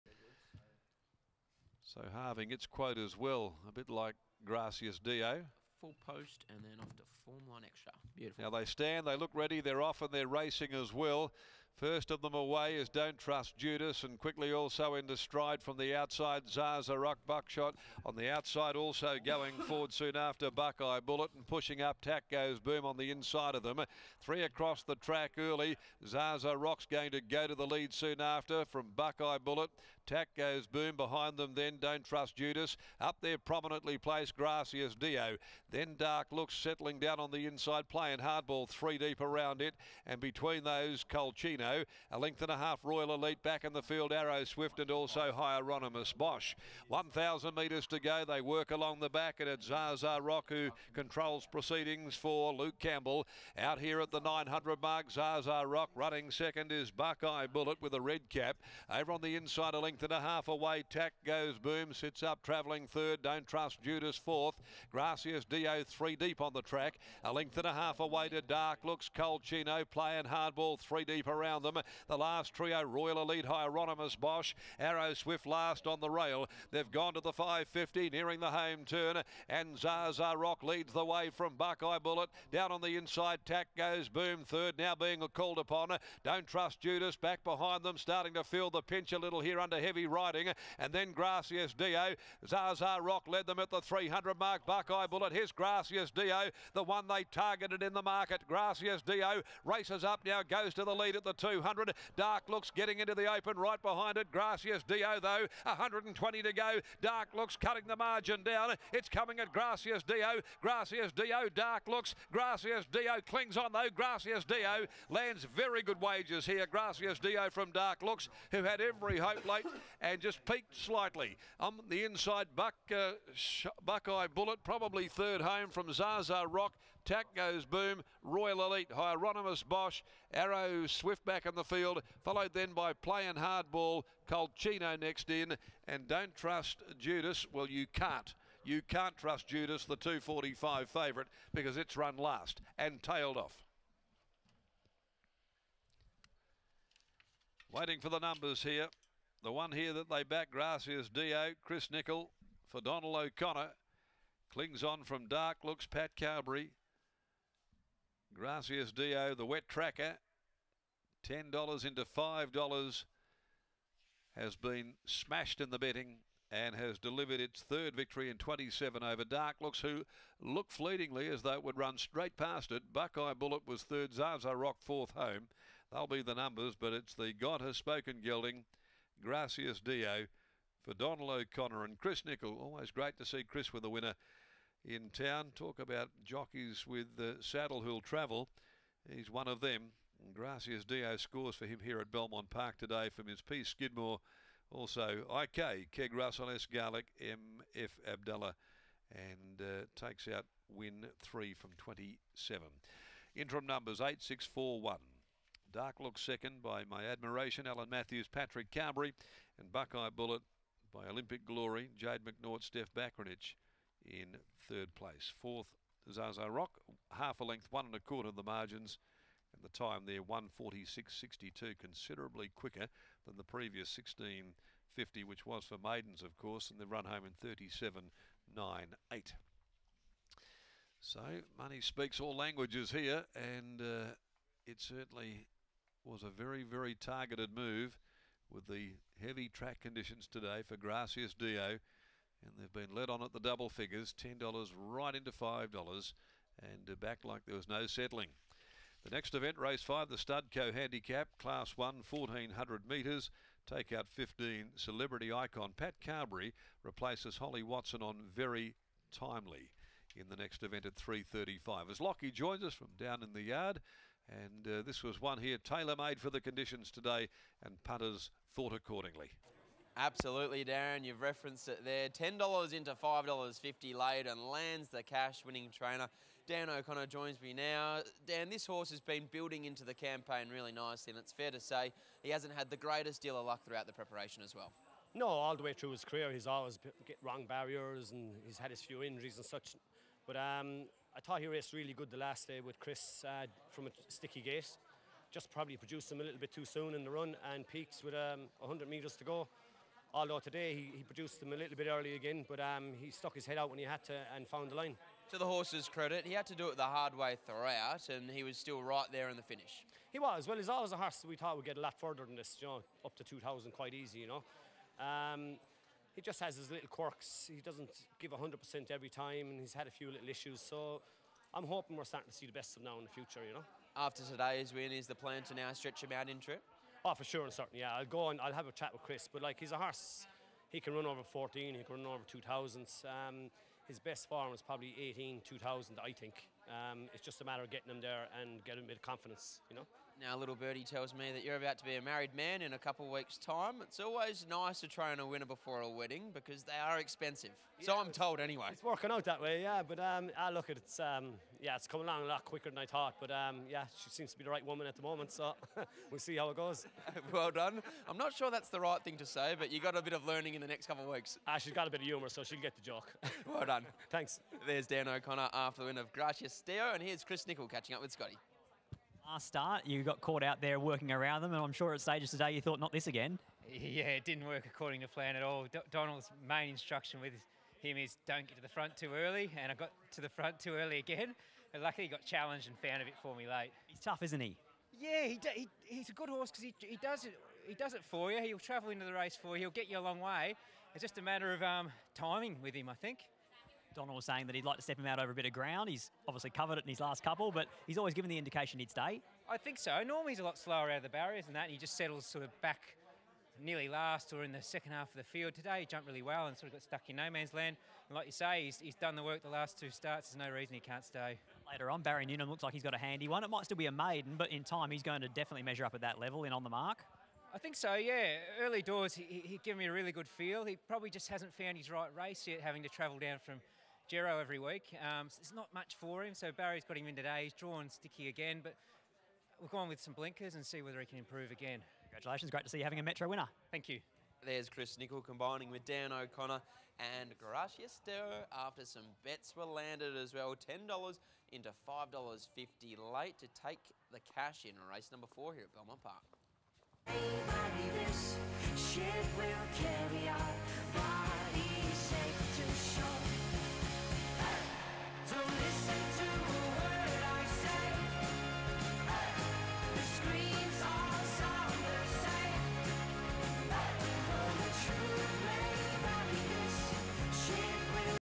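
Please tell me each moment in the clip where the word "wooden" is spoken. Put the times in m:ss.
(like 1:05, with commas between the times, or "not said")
not said.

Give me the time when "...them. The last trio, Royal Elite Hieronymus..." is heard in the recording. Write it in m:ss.
1:11.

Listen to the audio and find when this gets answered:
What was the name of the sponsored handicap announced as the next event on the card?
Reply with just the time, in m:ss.
4:10.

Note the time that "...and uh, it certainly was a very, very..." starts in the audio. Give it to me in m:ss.
3:53.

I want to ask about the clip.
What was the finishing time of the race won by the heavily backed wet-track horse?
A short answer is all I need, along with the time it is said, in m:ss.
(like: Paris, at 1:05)
146.62, at 3:40.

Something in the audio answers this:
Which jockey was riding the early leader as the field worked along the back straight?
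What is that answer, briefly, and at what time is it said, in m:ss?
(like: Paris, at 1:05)
Luke Campbell, at 0:52.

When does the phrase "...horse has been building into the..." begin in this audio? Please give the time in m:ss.
4:38.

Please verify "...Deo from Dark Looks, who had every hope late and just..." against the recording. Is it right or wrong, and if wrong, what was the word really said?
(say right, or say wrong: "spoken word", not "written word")
right.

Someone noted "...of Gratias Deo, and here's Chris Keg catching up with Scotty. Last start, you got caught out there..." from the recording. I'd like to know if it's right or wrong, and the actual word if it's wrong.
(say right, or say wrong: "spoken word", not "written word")
wrong: "Nickel", not "Keg".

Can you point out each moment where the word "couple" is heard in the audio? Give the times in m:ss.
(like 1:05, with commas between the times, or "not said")
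5:42, 6:00, 6:37.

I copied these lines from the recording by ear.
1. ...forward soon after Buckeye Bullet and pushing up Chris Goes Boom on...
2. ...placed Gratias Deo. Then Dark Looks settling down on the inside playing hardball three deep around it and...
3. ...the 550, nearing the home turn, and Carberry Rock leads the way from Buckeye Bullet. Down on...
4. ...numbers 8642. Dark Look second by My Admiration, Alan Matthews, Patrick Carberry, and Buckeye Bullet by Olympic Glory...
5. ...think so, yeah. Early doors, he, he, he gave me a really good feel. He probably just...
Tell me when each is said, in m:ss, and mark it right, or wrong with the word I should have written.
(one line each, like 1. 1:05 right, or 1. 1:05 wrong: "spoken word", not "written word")
1. 0:19 wrong: "Tack", not "Chris"
2. 0:33 right
3. 1:17 wrong: "Zaza", not "Carberry"
4. 3:23 wrong: "8641", not "8642"
5. 6:57 right.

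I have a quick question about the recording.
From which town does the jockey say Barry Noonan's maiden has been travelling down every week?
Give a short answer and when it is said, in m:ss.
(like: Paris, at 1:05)
Jero, at 7:04.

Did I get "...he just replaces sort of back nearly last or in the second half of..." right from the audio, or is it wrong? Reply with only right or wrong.
wrong.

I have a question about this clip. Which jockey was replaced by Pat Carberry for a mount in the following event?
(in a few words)
Holly Watson.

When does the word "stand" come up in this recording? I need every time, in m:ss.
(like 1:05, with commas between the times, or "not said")
0:08.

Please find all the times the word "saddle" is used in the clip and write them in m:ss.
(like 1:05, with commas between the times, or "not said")
3:07.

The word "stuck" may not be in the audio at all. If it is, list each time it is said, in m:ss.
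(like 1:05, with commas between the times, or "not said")
5:03, 6:46.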